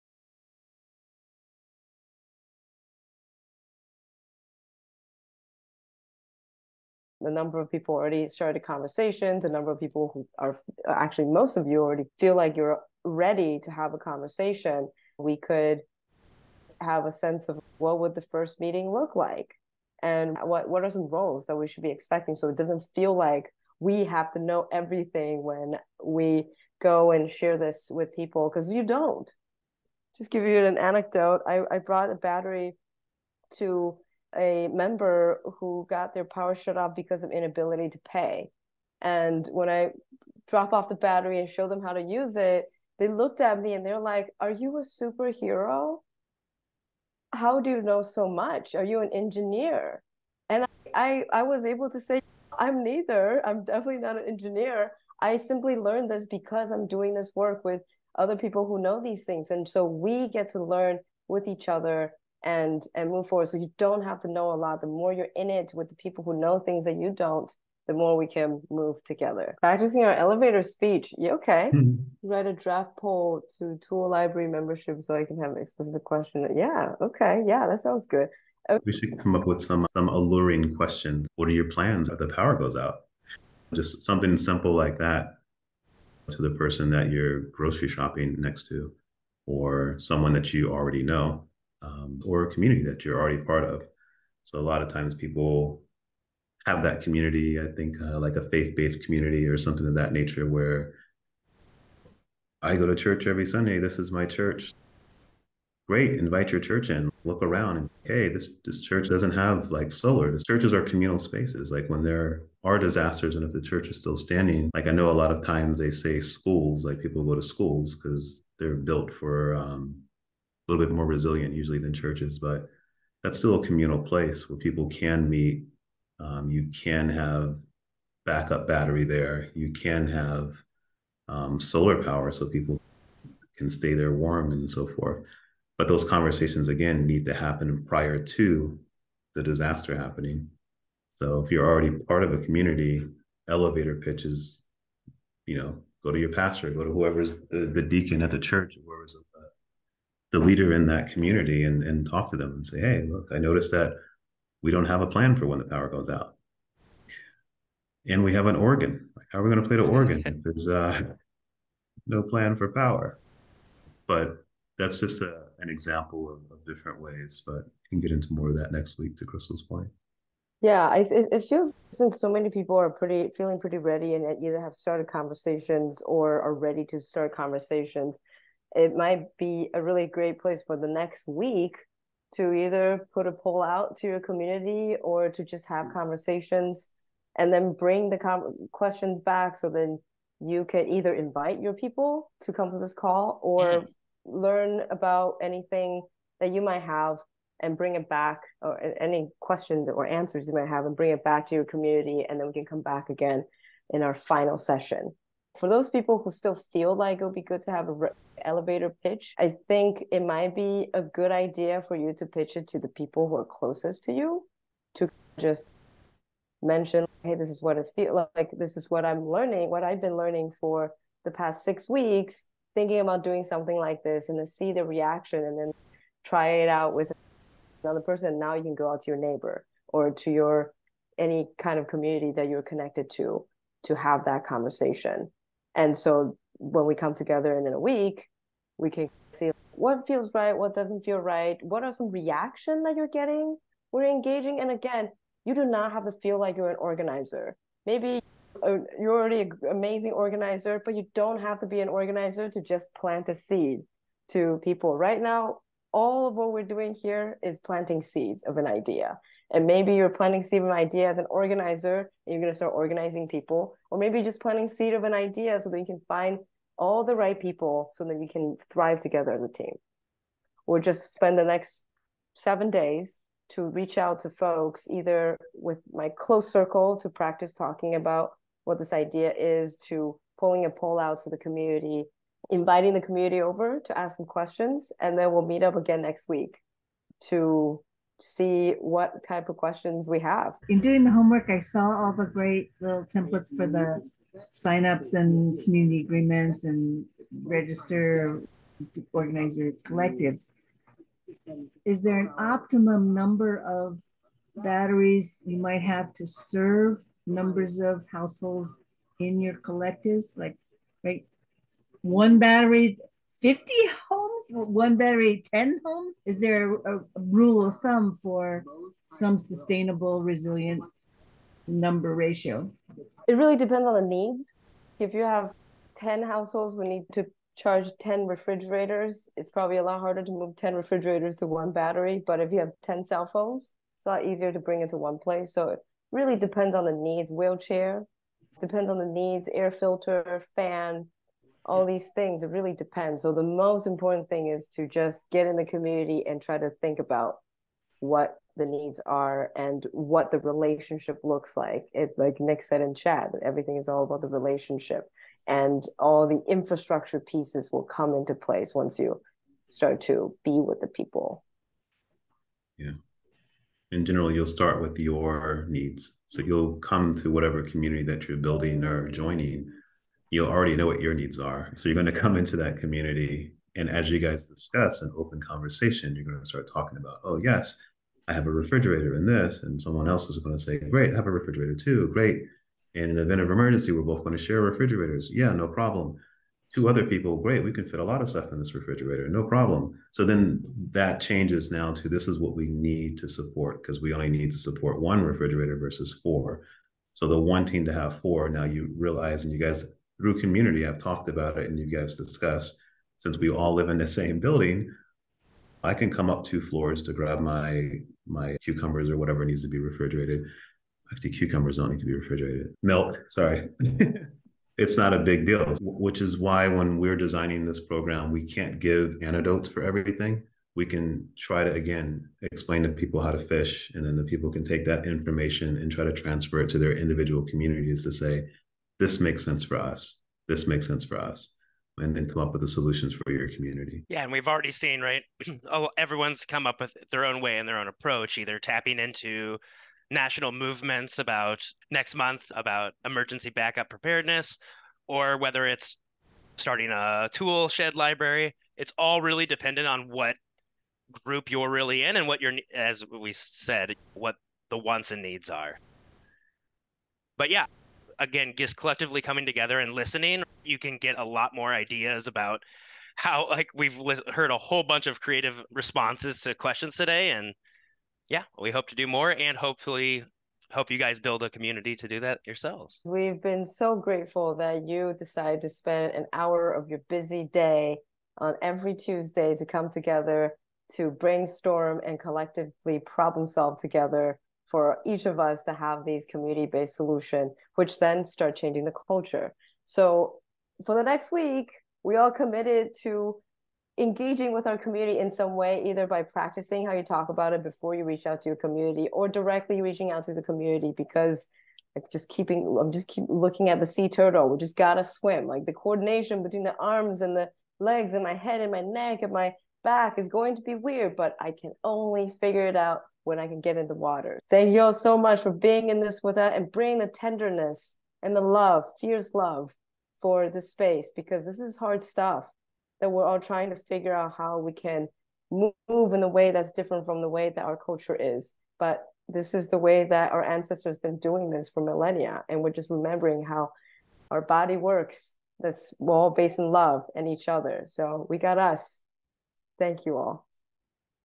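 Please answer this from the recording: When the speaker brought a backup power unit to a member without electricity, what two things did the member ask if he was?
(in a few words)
A superhero.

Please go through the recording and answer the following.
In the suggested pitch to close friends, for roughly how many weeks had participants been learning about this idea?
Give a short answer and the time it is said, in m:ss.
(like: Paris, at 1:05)
6, at 3:41.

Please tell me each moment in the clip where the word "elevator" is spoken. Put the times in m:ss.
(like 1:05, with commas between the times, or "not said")
1:10, 2:23, 3:28.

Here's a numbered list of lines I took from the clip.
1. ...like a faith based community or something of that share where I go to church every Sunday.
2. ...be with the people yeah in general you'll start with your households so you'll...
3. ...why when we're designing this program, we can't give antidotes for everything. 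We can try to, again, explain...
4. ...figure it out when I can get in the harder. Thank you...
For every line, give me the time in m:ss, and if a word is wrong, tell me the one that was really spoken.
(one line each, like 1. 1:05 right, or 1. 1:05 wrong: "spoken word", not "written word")
1. 1:38 wrong: "nature", not "share"
2. 6:00 wrong: "needs", not "households"
3. 6:56 right
4. 8:32 wrong: "water", not "harder".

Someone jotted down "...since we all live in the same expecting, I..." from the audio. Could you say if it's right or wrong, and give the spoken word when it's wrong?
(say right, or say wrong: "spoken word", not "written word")
wrong: "building", not "expecting".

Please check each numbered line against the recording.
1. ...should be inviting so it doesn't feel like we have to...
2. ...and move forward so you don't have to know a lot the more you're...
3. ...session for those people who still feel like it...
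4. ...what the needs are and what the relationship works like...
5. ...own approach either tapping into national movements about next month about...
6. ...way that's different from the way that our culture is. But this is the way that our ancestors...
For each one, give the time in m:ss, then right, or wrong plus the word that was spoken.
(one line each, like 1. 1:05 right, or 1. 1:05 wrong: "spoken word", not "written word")
1. 0:21 wrong: "expecting", not "inviting"
2. 1:02 right
3. 3:24 right
4. 5:47 wrong: "looks", not "works"
5. 7:17 right
6. 8:46 right.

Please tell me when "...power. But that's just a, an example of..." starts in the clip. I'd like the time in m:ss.
2:42.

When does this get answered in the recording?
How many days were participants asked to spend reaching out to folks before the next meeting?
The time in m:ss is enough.
4:32.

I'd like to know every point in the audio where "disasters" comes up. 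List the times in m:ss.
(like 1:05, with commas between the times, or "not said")
1:52, 2:19.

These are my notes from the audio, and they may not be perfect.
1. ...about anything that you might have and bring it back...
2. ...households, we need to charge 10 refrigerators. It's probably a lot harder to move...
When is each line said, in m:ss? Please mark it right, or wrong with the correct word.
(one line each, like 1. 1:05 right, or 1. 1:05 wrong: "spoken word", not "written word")
1. 3:14 right
2. 5:26 right.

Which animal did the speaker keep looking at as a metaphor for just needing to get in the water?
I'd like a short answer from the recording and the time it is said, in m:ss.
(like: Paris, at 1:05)
Sea turtle, at 8:23.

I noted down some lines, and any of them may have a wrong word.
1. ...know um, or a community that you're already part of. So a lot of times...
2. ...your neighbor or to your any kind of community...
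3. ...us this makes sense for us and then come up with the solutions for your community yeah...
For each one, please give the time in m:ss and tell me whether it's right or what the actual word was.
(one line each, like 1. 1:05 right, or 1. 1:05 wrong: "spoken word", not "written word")
1. 1:31 right
2. 3:49 right
3. 7:09 right.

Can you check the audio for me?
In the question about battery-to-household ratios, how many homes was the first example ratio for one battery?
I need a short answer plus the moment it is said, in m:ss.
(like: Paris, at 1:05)
50, at 5:13.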